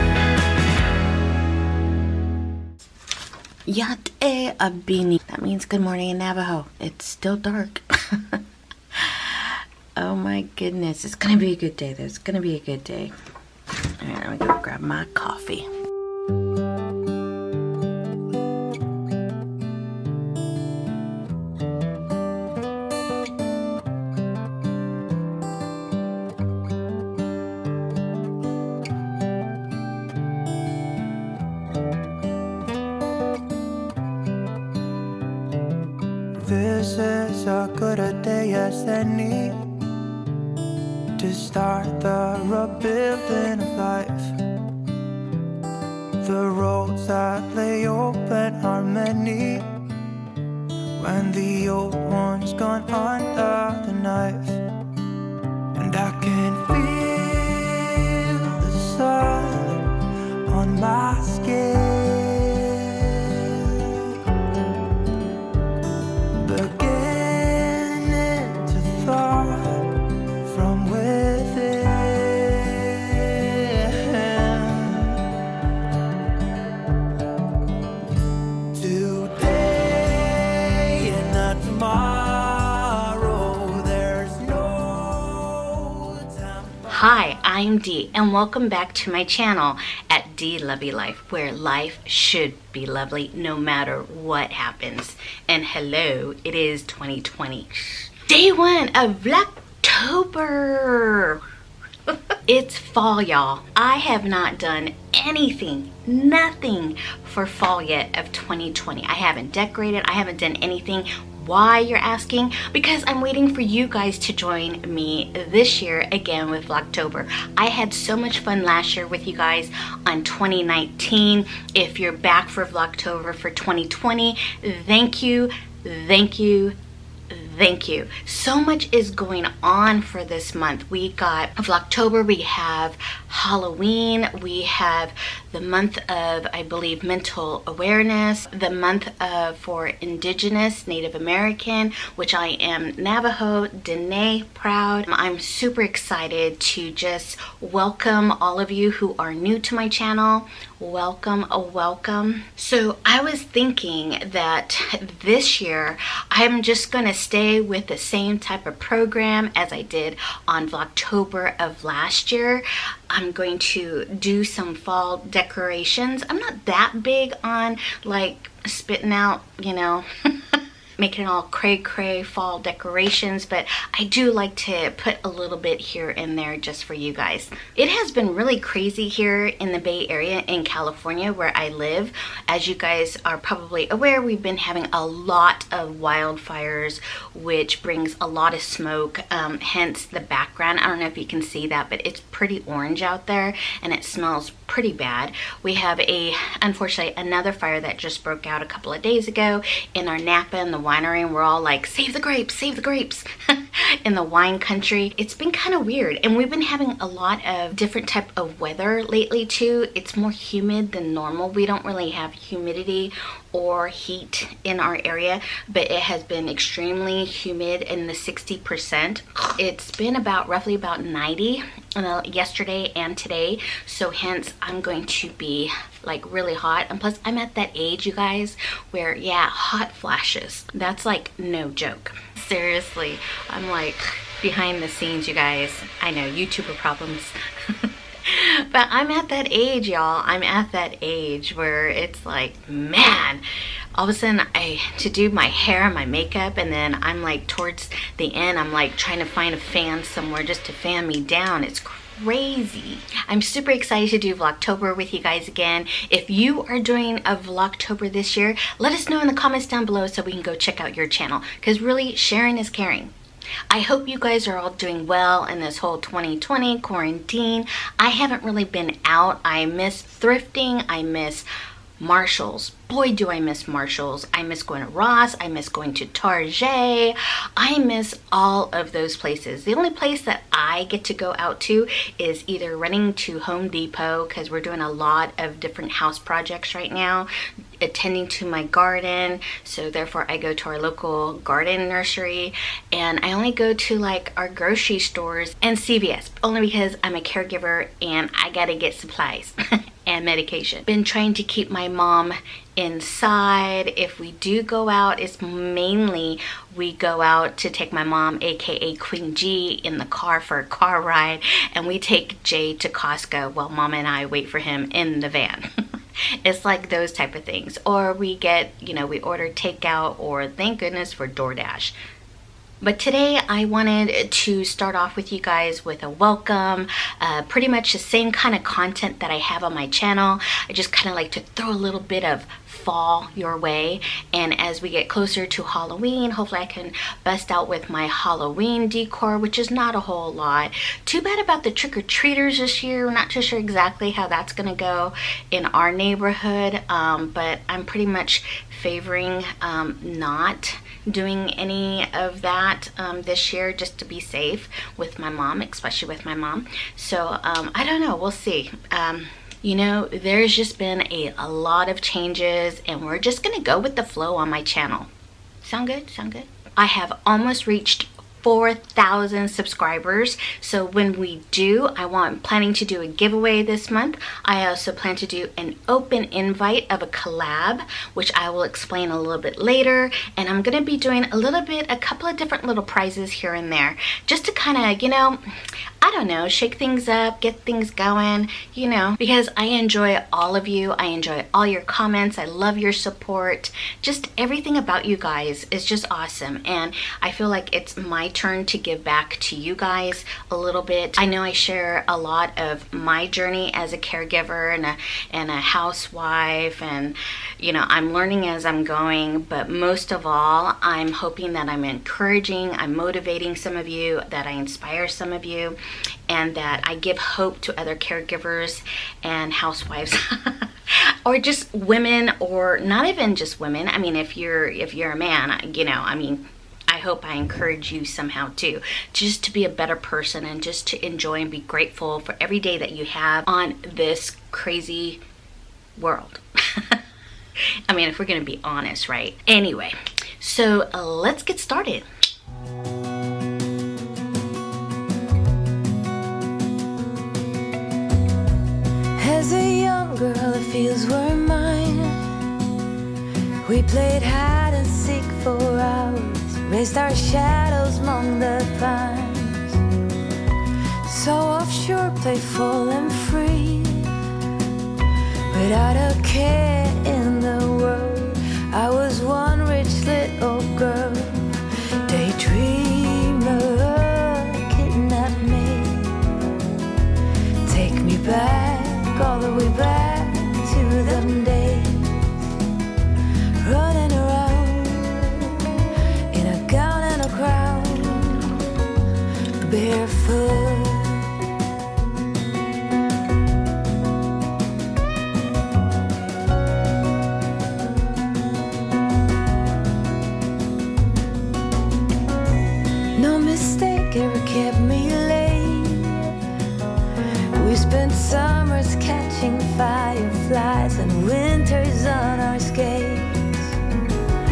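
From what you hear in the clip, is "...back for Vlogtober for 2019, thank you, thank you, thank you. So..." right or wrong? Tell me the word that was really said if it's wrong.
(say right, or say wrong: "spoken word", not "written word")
wrong: "2020", not "2019".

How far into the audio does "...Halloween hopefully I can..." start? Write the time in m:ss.
5:35.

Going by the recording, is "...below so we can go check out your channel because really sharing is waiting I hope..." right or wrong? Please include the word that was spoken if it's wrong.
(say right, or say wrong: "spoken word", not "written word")
wrong: "caring", not "waiting".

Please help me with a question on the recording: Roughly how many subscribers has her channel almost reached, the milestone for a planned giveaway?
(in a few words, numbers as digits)
4,000.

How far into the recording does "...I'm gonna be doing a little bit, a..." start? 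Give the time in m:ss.
6:20.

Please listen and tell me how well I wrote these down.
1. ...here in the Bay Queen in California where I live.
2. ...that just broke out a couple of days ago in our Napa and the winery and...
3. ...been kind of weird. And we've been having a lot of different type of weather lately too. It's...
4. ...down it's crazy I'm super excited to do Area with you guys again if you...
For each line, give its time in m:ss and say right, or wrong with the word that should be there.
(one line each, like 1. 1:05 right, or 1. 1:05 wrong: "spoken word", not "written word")
1. 2:59 wrong: "Area", not "Queen"
2. 3:17 right
3. 3:25 right
4. 4:11 wrong: "Vlogtober", not "Area".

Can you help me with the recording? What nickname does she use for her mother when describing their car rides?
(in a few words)
Queen G.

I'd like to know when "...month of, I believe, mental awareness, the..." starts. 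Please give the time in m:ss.
2:15.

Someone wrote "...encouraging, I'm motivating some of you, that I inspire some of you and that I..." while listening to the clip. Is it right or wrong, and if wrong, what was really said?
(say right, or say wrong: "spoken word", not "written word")
right.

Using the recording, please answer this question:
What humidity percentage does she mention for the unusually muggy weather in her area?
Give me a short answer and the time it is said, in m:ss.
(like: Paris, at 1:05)
60%, at 3:38.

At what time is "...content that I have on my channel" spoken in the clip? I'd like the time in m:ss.
5:28.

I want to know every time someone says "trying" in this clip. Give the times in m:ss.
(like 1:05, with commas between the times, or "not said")
4:08, 5:01.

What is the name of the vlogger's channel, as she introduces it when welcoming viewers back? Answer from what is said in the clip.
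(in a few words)
Dee Lovely Life.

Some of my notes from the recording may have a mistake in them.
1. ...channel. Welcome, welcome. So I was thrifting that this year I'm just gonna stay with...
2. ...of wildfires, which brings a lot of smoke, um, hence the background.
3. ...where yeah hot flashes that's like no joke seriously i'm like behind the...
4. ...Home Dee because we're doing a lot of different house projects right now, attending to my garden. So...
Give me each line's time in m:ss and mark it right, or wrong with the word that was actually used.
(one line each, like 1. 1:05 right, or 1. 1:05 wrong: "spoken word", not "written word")
1. 2:29 wrong: "thinking", not "thrifting"
2. 3:05 right
3. 3:48 right
4. 4:43 wrong: "Depot", not "Dee".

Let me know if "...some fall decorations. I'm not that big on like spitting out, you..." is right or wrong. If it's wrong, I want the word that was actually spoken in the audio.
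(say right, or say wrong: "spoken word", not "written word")
right.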